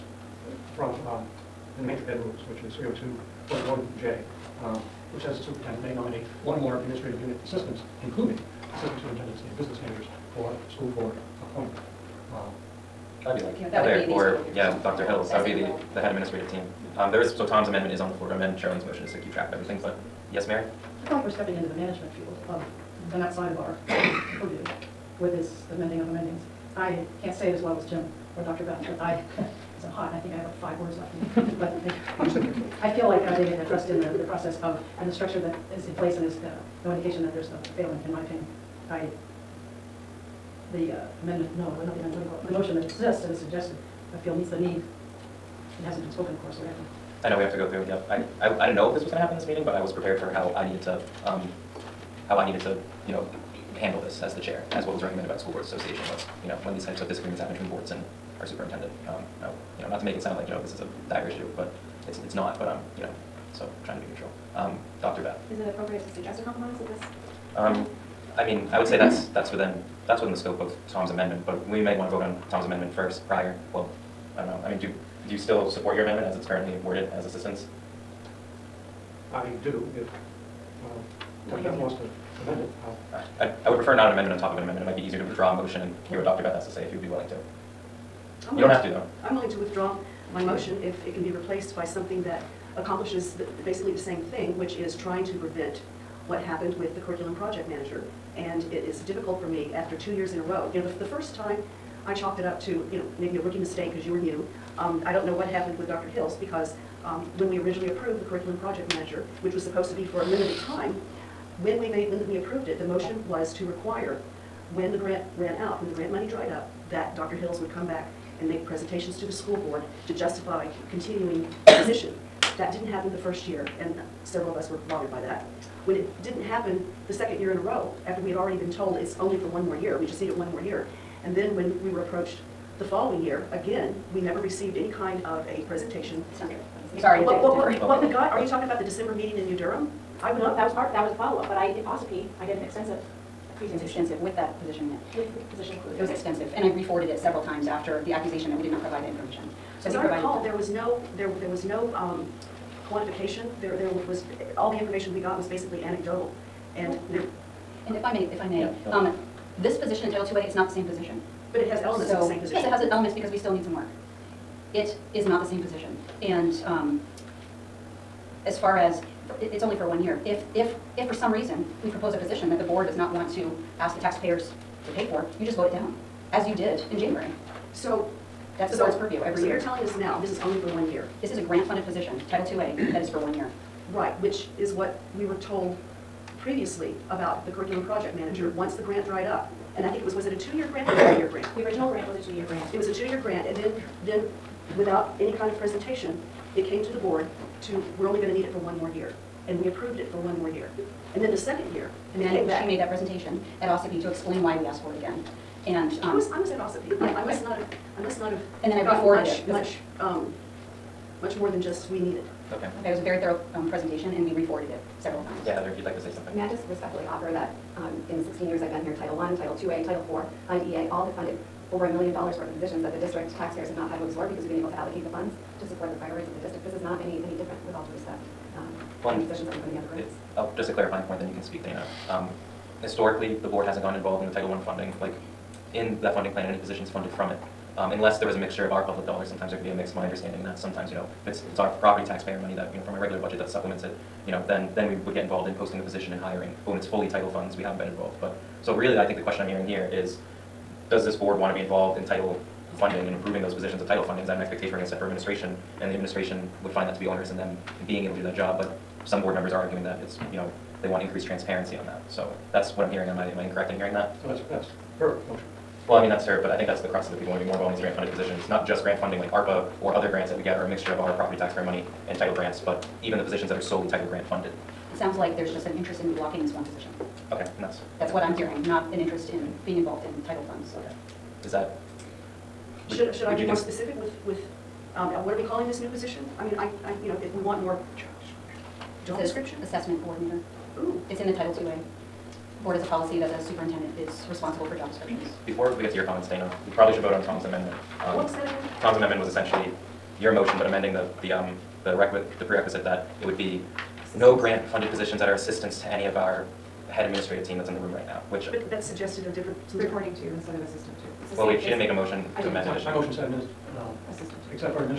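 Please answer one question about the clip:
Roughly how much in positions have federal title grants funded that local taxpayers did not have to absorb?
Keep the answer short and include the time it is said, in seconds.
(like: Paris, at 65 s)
over a million dollars, at 221 s.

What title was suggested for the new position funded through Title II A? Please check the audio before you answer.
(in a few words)
Assessment coordinator.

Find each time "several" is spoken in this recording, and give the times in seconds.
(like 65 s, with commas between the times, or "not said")
124 s, 147 s, 214 s.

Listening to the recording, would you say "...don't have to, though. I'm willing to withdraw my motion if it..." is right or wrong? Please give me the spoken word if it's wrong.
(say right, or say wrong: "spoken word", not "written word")
right.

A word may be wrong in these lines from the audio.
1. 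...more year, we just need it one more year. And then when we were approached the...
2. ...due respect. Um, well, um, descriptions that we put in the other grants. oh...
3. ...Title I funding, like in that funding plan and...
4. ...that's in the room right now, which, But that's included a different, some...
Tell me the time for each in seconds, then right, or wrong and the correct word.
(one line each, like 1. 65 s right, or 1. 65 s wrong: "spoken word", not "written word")
1. 129 s right
2. 227 s wrong: "positions", not "descriptions"
3. 234 s right
4. 307 s wrong: "suggested", not "included".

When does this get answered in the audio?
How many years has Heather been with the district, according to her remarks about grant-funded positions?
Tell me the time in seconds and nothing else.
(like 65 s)
218 s.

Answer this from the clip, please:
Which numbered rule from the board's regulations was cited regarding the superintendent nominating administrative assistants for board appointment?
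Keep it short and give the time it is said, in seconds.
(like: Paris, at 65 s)
302.1J, at 2 s.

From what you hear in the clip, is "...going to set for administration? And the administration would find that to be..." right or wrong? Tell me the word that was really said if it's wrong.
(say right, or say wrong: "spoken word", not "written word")
right.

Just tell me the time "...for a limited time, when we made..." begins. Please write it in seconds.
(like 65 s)
110 s.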